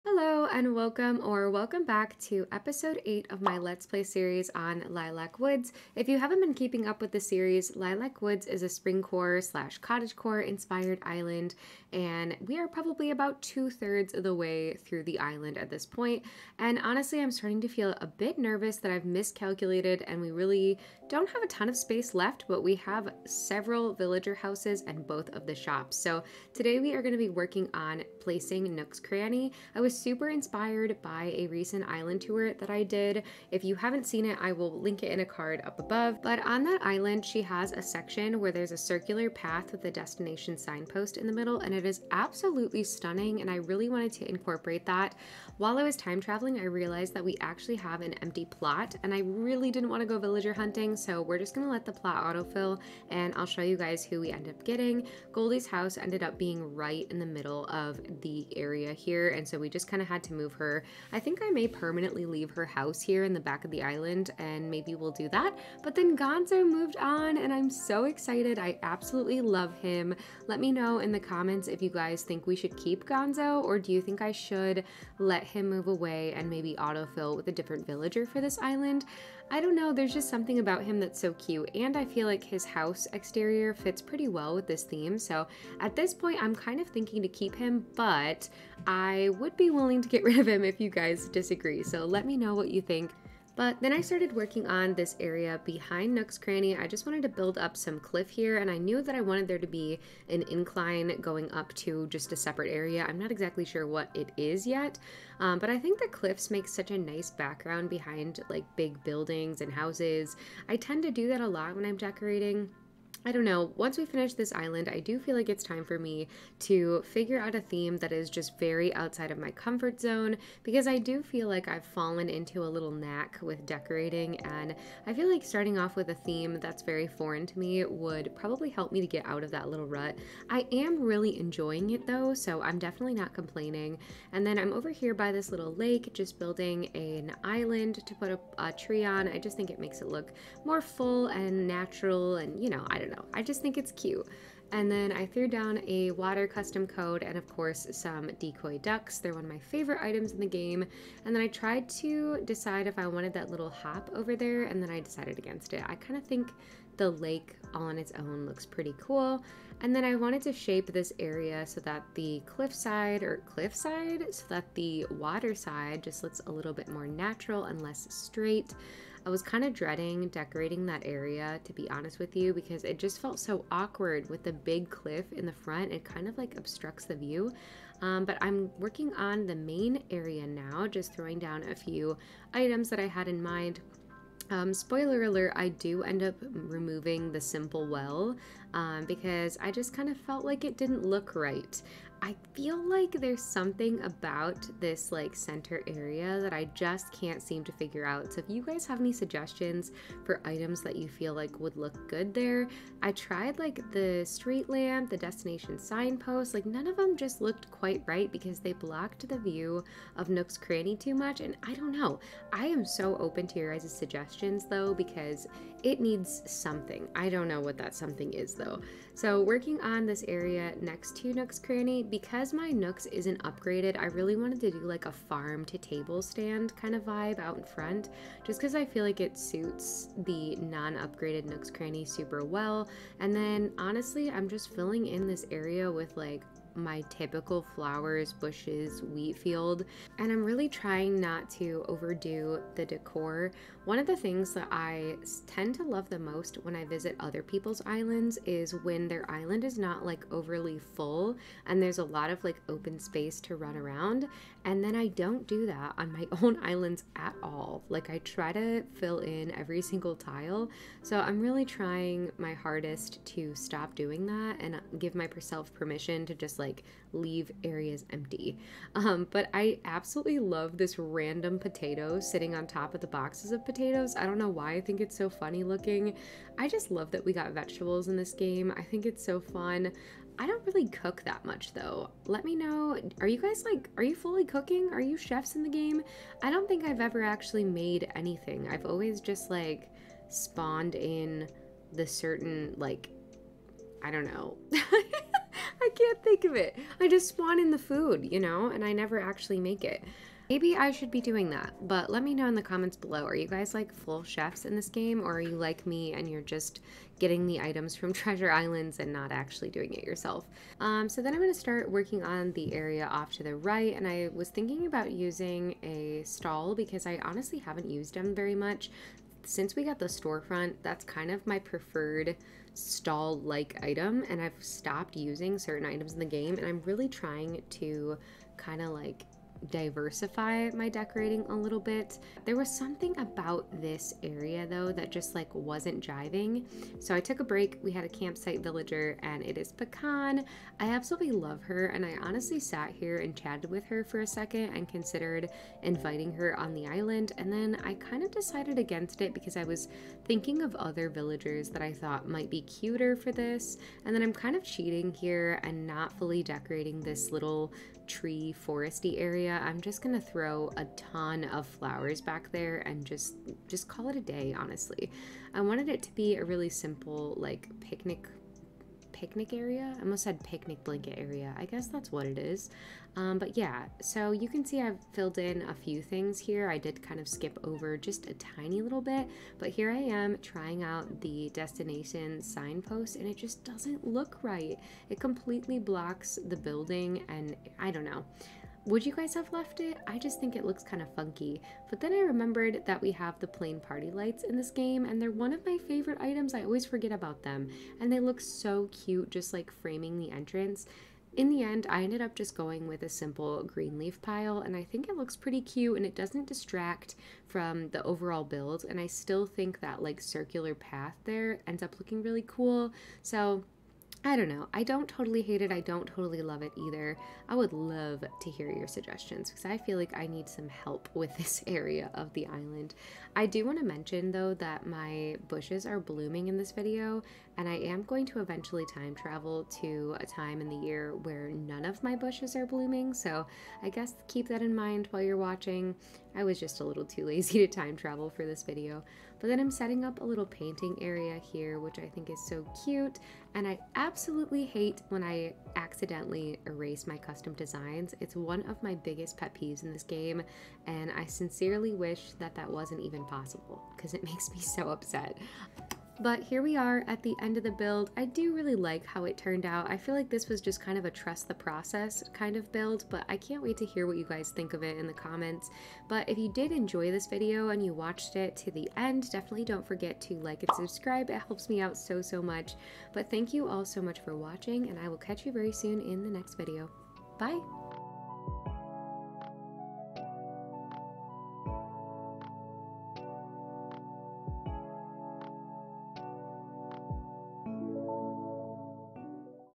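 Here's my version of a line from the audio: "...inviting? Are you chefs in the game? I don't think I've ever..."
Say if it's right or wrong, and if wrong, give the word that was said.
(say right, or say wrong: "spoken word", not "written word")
wrong: "cooking", not "inviting".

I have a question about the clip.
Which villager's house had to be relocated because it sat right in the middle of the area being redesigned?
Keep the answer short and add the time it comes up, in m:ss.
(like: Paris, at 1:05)
Goldie, at 0:55.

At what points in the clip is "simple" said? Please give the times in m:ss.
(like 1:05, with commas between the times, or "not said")
3:07, 6:06, 6:43.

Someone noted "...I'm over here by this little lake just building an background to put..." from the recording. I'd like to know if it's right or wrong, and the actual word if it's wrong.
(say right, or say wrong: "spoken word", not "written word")
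wrong: "island", not "background".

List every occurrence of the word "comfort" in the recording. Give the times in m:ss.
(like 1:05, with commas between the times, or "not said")
1:59.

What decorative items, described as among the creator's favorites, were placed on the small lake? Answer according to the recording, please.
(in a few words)
decoy ducks.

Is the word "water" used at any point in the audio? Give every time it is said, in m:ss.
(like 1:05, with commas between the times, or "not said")
2:26, 2:45.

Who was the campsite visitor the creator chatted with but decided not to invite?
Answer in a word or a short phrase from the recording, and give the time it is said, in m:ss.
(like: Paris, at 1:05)
Pecan, at 5:39.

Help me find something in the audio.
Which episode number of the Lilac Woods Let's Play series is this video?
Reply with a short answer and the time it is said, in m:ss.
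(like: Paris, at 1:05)
8, at 0:02.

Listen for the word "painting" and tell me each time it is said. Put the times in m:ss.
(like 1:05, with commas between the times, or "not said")
7:20.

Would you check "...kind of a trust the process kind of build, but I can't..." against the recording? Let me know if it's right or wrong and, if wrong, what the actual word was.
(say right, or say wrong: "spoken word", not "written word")
right.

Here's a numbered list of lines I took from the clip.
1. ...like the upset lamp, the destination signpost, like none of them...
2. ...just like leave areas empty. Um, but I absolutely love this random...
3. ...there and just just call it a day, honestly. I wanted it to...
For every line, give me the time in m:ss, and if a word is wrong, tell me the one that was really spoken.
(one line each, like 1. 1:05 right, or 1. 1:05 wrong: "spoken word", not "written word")
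1. 3:23 wrong: "street", not "upset"
2. 4:26 right
3. 6:02 right.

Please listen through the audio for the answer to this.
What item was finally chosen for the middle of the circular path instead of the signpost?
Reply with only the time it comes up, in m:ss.
6:43.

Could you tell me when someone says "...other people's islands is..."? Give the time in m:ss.
4:07.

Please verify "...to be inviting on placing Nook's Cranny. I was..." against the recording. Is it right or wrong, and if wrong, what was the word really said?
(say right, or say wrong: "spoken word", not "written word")
wrong: "working", not "inviting".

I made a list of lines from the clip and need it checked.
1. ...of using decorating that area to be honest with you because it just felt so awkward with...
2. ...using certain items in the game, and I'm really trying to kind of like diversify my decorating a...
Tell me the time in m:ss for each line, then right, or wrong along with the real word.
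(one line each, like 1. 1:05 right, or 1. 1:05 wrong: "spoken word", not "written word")
1. 2:49 wrong: "dreading", not "using"
2. 5:25 right.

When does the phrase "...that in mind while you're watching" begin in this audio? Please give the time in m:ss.
7:14.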